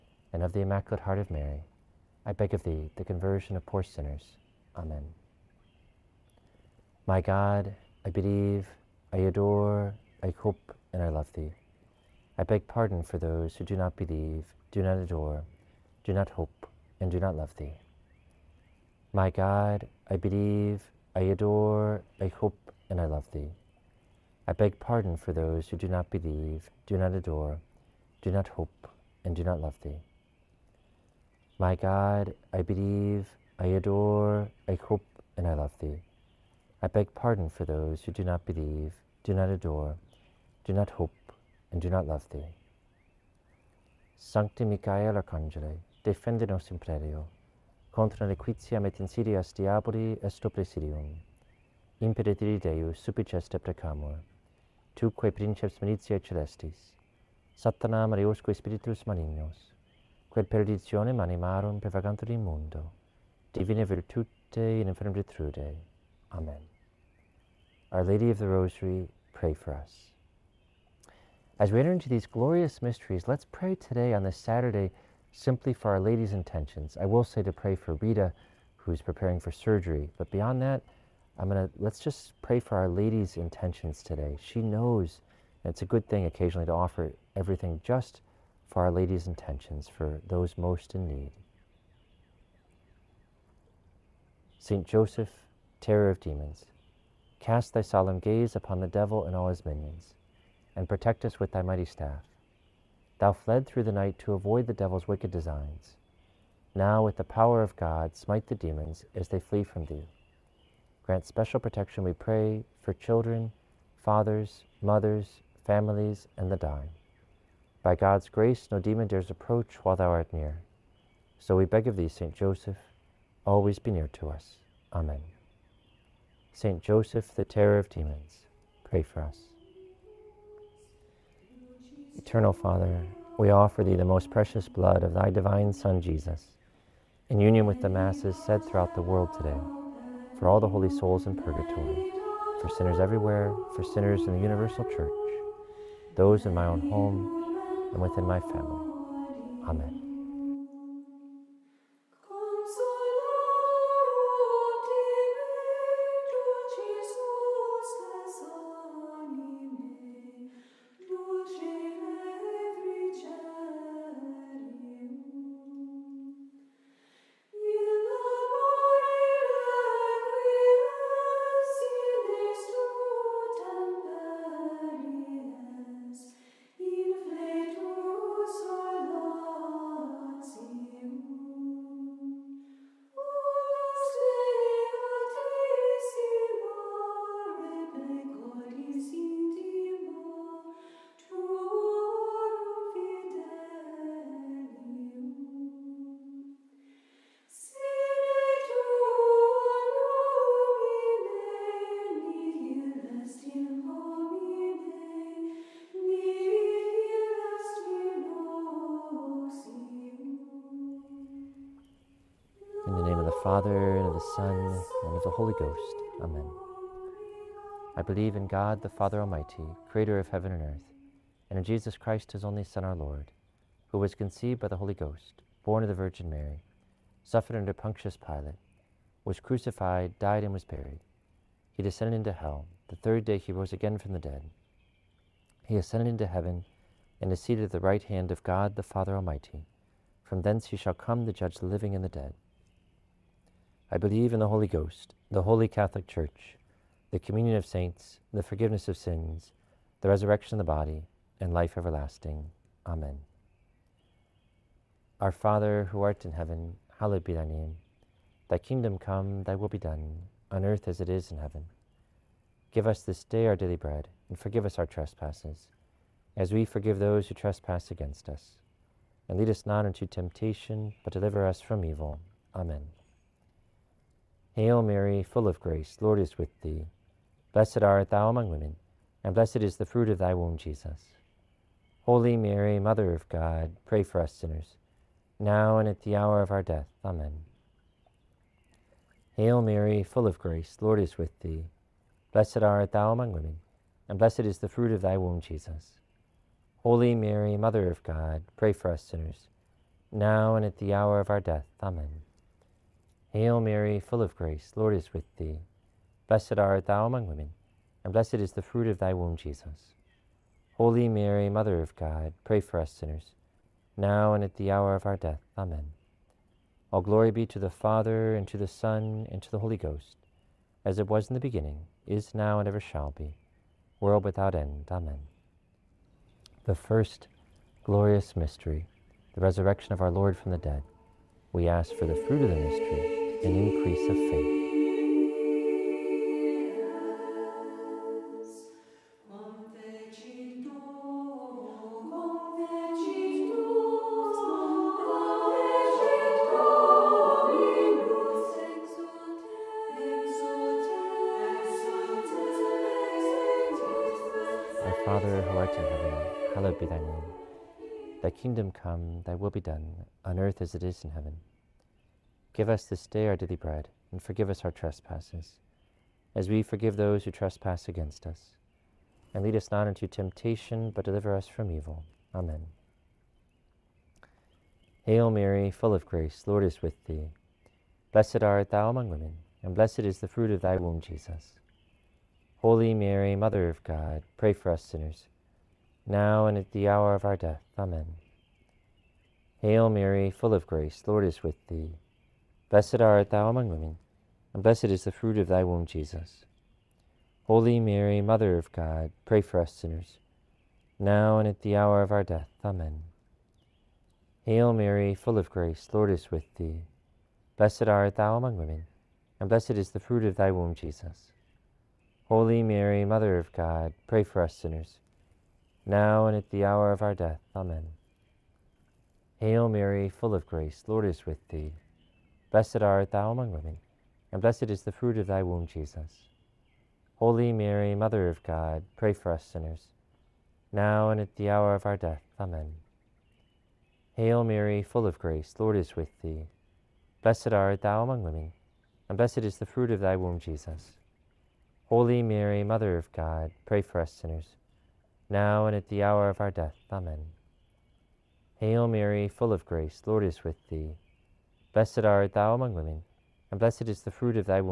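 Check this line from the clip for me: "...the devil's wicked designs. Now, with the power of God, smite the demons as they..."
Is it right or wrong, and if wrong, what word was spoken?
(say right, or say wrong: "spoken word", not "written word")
right.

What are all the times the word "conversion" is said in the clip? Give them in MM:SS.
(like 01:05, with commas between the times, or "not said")
00:03.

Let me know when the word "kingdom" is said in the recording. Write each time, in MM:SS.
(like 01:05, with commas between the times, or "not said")
04:18, 05:58.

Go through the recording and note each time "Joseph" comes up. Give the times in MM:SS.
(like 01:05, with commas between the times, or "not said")
01:34, 02:02, 02:06.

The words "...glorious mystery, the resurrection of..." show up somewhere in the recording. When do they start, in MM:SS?
05:27.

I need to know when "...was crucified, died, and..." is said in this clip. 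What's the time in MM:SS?
03:49.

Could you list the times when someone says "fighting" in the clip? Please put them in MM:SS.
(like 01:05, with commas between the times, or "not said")
not said.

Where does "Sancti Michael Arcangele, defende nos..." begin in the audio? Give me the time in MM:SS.
00:44.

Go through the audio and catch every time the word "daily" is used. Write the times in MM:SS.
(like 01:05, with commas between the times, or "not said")
04:23, 06:03.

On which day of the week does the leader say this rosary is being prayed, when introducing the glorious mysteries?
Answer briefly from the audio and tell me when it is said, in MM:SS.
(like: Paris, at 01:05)
Saturday, at 01:14.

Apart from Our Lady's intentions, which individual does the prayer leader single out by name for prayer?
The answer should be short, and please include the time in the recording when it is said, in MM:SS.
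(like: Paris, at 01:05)
Rita, at 01:17.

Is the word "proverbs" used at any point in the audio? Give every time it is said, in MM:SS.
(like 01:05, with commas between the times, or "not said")
not said.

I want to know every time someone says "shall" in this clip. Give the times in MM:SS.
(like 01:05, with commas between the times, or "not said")
04:00, 05:22.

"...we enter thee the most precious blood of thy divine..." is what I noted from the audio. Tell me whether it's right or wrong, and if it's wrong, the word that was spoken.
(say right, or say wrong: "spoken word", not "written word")
wrong: "offer", not "enter".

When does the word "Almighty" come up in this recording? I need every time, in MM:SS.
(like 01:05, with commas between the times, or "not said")
03:39, 03:59.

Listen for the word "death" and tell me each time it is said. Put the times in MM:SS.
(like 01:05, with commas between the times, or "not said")
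04:46, 05:01, 05:15, 06:27, 06:42, 06:57, 07:11, 07:26.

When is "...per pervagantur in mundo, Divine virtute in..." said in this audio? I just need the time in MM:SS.
01:01.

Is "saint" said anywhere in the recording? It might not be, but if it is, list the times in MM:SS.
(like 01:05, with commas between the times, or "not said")
01:34, 02:02, 02:06, 04:07.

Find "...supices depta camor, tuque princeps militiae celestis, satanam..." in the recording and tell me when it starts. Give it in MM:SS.
00:52.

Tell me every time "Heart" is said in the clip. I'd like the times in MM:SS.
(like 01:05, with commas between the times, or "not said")
00:01.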